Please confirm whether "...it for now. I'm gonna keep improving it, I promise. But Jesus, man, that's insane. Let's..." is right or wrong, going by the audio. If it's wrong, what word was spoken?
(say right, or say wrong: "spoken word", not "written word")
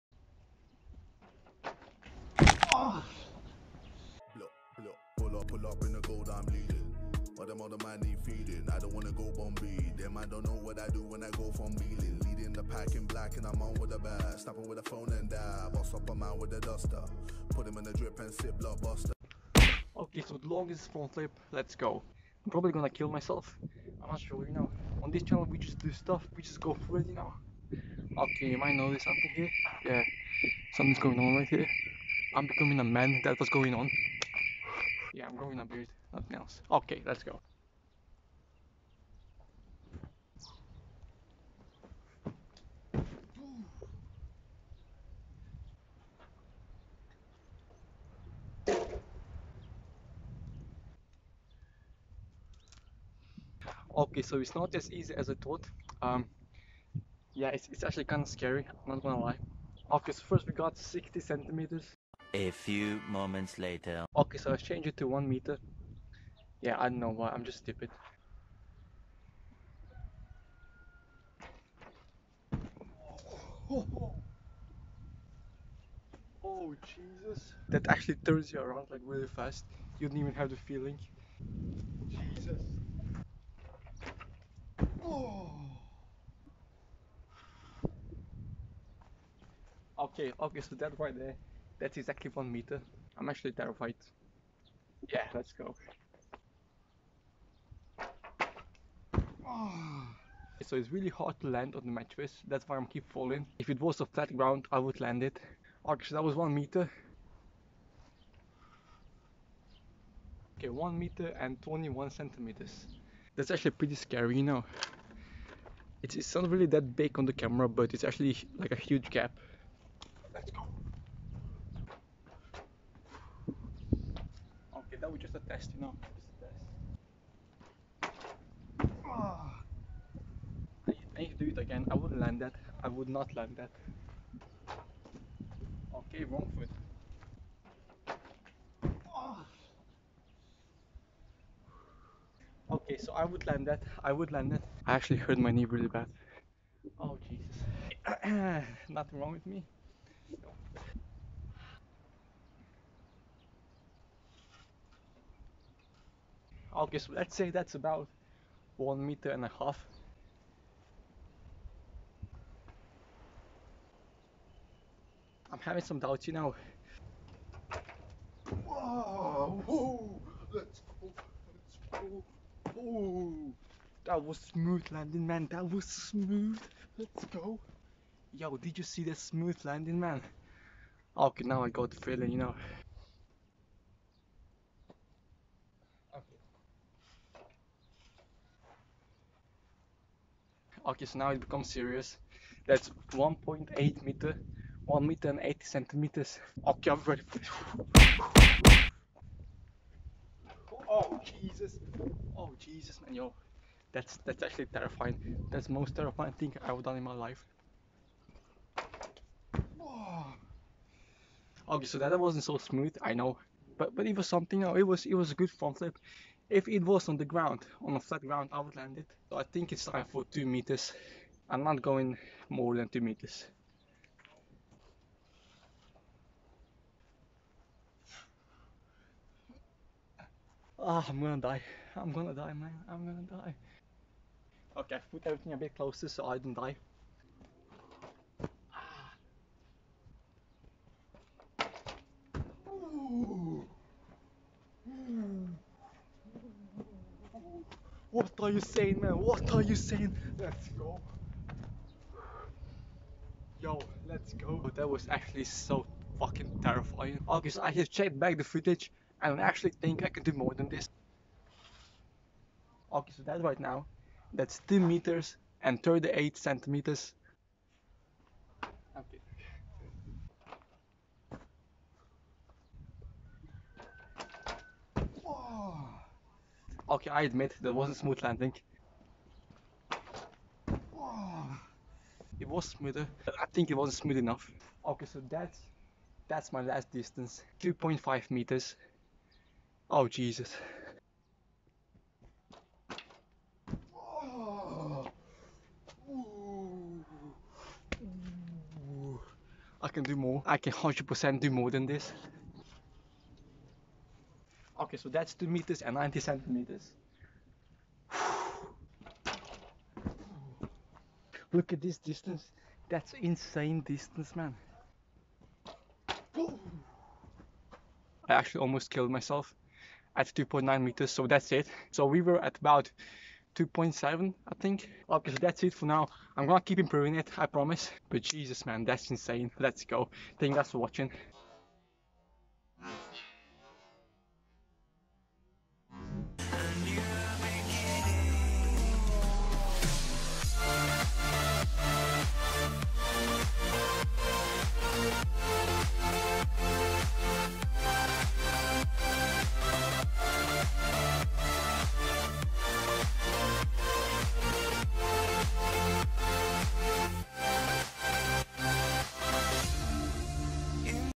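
right.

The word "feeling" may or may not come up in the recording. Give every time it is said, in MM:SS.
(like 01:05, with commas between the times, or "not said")
01:20, 03:01.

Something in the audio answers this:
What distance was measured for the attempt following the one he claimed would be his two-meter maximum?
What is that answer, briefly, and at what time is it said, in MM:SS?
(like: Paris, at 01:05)
2 meters 38 centimeters, at 04:24.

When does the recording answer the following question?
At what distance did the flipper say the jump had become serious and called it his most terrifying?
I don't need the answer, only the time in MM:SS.
03:13.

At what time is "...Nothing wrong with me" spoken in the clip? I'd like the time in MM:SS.
02:28.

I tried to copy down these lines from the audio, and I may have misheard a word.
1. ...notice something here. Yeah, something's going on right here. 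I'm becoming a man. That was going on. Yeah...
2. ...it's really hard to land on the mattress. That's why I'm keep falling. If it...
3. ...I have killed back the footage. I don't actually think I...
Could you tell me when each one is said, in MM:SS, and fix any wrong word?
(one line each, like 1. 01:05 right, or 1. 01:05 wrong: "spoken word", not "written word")
1. 00:28 right
2. 01:40 right
3. 04:17 wrong: "checked", not "killed".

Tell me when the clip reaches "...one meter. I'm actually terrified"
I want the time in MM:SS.
01:32.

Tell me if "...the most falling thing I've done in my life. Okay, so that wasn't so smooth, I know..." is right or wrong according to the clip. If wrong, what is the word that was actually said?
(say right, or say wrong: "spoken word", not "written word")
wrong: "terrifying", not "falling".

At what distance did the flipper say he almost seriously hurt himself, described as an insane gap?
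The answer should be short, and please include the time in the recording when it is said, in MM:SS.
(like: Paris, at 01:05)
2.9 meters, at 05:20.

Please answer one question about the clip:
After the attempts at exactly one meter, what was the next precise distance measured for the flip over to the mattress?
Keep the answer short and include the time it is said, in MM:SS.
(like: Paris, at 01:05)
1 meter 21 centimeters, at 01:50.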